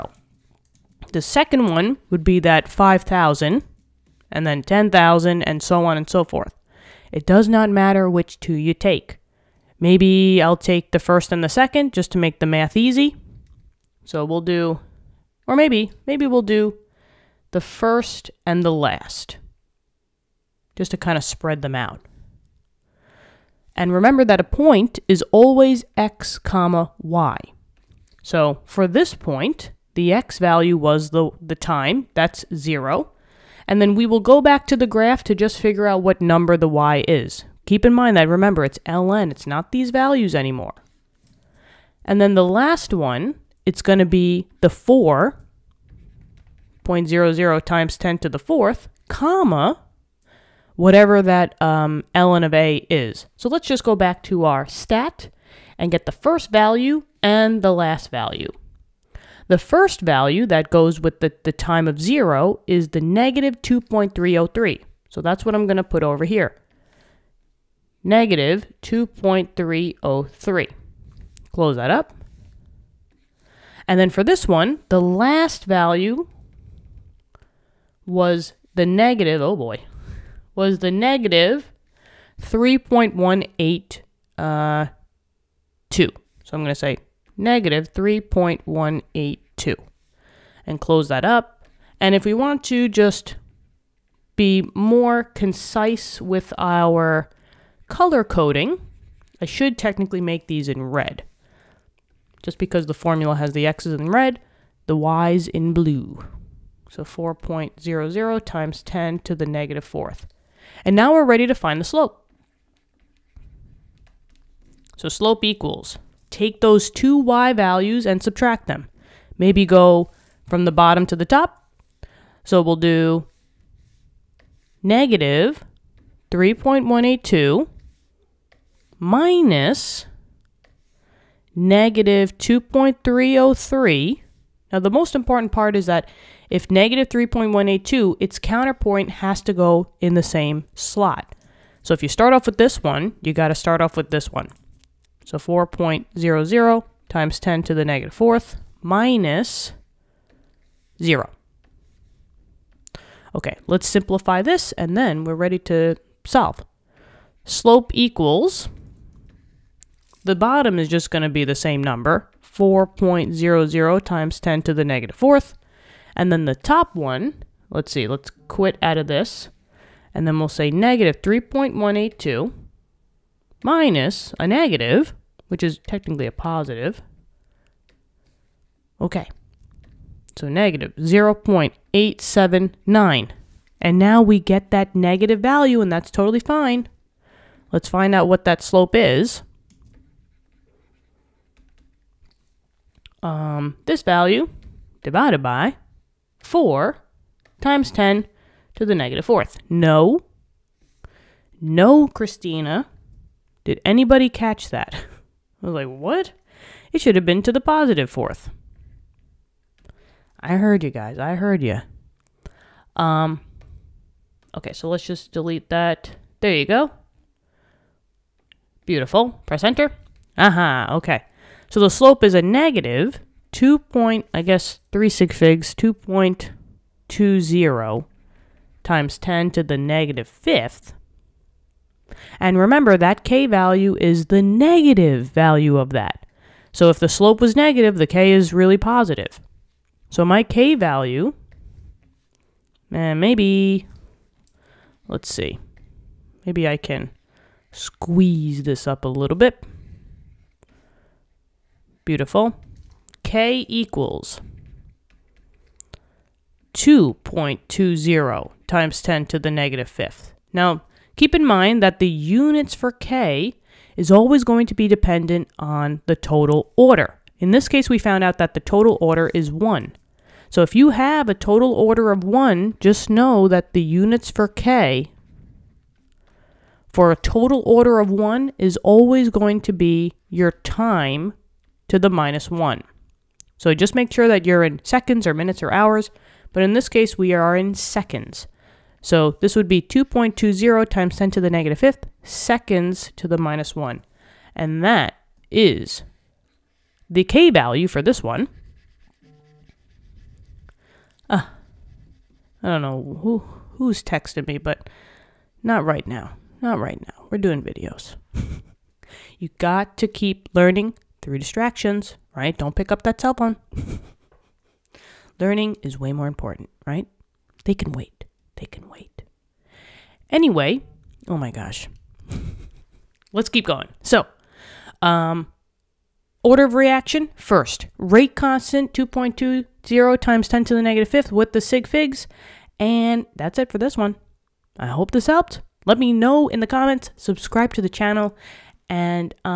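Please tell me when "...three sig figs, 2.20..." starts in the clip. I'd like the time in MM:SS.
03:44.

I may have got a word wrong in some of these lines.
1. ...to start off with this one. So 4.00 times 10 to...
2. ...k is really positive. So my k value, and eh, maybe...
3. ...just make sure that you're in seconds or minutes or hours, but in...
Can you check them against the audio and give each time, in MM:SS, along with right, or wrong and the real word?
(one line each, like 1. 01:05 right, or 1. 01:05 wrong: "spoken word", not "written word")
1. 02:23 right
2. 03:58 right
3. 04:43 right.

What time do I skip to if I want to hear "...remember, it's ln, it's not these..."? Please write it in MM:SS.
00:38.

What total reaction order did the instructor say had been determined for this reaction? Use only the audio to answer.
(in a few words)
1.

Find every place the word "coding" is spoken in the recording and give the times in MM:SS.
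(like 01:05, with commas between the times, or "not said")
01:38.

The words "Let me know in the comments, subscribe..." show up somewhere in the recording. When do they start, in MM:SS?
05:35.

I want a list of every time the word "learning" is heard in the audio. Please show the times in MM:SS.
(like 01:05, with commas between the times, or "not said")
05:10, 05:15.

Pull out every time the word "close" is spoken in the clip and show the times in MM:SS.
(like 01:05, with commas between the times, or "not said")
01:11, 01:30.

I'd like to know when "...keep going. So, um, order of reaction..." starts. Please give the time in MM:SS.
05:23.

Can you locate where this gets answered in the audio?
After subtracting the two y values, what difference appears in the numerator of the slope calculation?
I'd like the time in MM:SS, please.
03:00.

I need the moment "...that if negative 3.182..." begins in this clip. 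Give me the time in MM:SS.
02:15.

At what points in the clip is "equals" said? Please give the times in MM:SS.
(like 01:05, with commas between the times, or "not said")
01:55, 02:37, 04:13.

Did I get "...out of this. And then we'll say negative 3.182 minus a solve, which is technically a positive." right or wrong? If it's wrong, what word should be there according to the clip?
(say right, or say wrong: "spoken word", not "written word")
wrong: "negative", not "solve".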